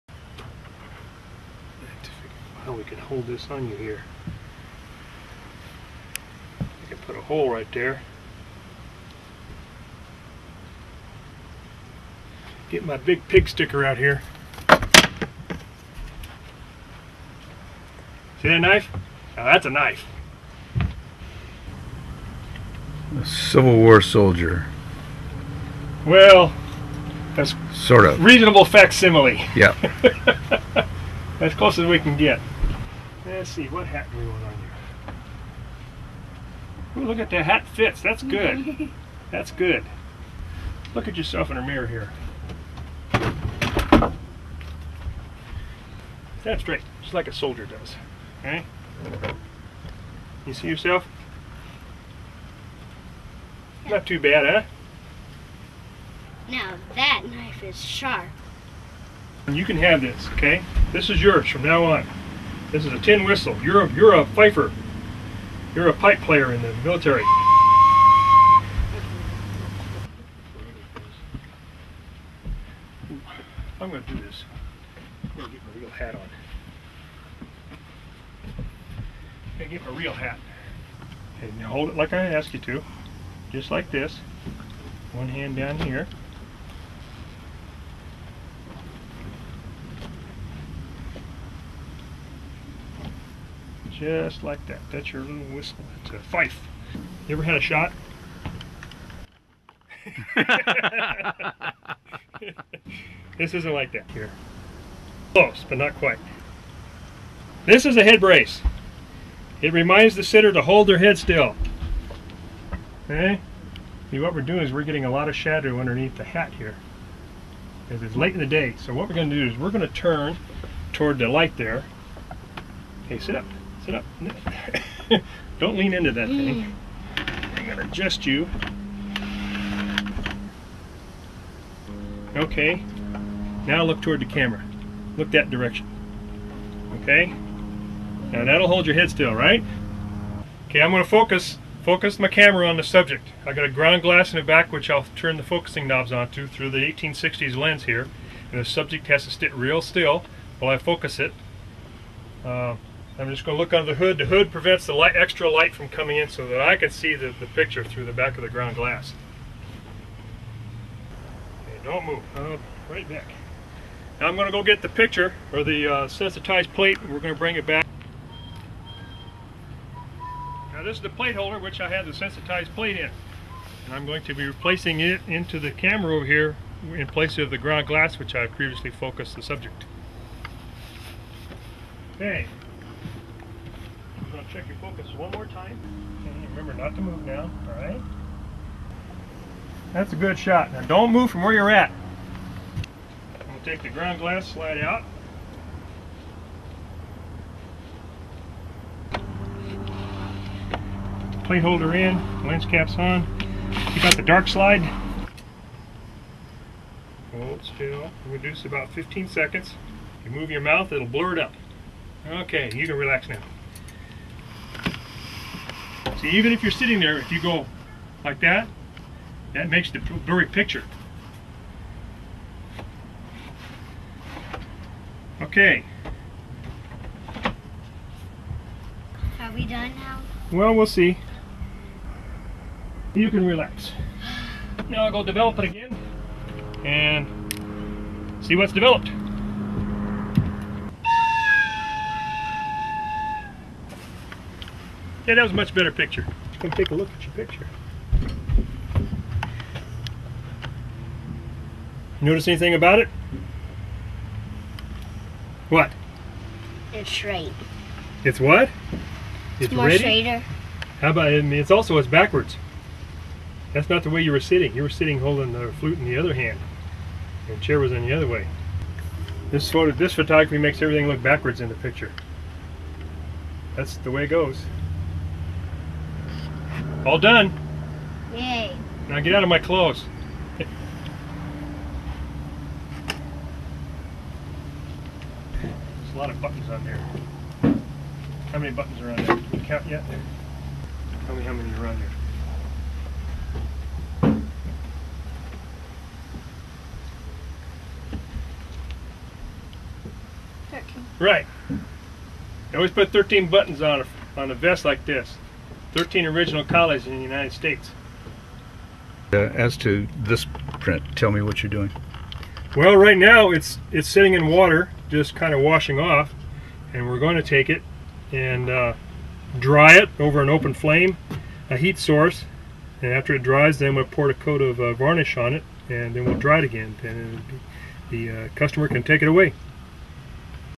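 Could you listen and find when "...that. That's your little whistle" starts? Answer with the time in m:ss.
1:34.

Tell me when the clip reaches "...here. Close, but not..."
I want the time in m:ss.
1:44.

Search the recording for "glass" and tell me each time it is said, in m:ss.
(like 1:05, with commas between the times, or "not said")
2:24, 2:38, 2:57, 3:14.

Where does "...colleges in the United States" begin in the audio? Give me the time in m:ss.
5:06.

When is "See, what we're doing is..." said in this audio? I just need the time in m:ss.
1:54.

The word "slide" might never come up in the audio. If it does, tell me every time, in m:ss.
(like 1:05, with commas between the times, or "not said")
3:14, 3:24.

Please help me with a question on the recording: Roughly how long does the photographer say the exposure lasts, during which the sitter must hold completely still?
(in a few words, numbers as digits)
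15 seconds.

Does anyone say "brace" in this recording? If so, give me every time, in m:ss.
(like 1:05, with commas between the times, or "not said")
1:48.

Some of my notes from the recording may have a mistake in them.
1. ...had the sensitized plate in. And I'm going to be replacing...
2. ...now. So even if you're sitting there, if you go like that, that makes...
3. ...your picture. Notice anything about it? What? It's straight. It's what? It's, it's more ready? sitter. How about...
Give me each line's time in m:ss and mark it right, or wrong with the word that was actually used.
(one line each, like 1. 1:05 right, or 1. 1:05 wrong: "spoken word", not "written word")
1. 2:51 right
2. 3:33 right
3. 4:07 wrong: "straighter", not "sitter".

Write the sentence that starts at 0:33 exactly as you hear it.
Let's see, what hat do we want on here?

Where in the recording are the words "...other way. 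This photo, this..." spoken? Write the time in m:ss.
4:28.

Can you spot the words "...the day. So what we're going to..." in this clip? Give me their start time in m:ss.
1:58.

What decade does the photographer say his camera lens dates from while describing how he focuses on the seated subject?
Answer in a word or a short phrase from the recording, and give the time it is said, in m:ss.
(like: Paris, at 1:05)
1860s, at 2:26.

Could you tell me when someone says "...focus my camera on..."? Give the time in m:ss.
2:21.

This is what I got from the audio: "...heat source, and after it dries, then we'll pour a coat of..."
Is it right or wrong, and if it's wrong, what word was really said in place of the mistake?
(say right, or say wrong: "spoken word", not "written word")
right.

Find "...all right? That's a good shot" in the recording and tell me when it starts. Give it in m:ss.
3:07.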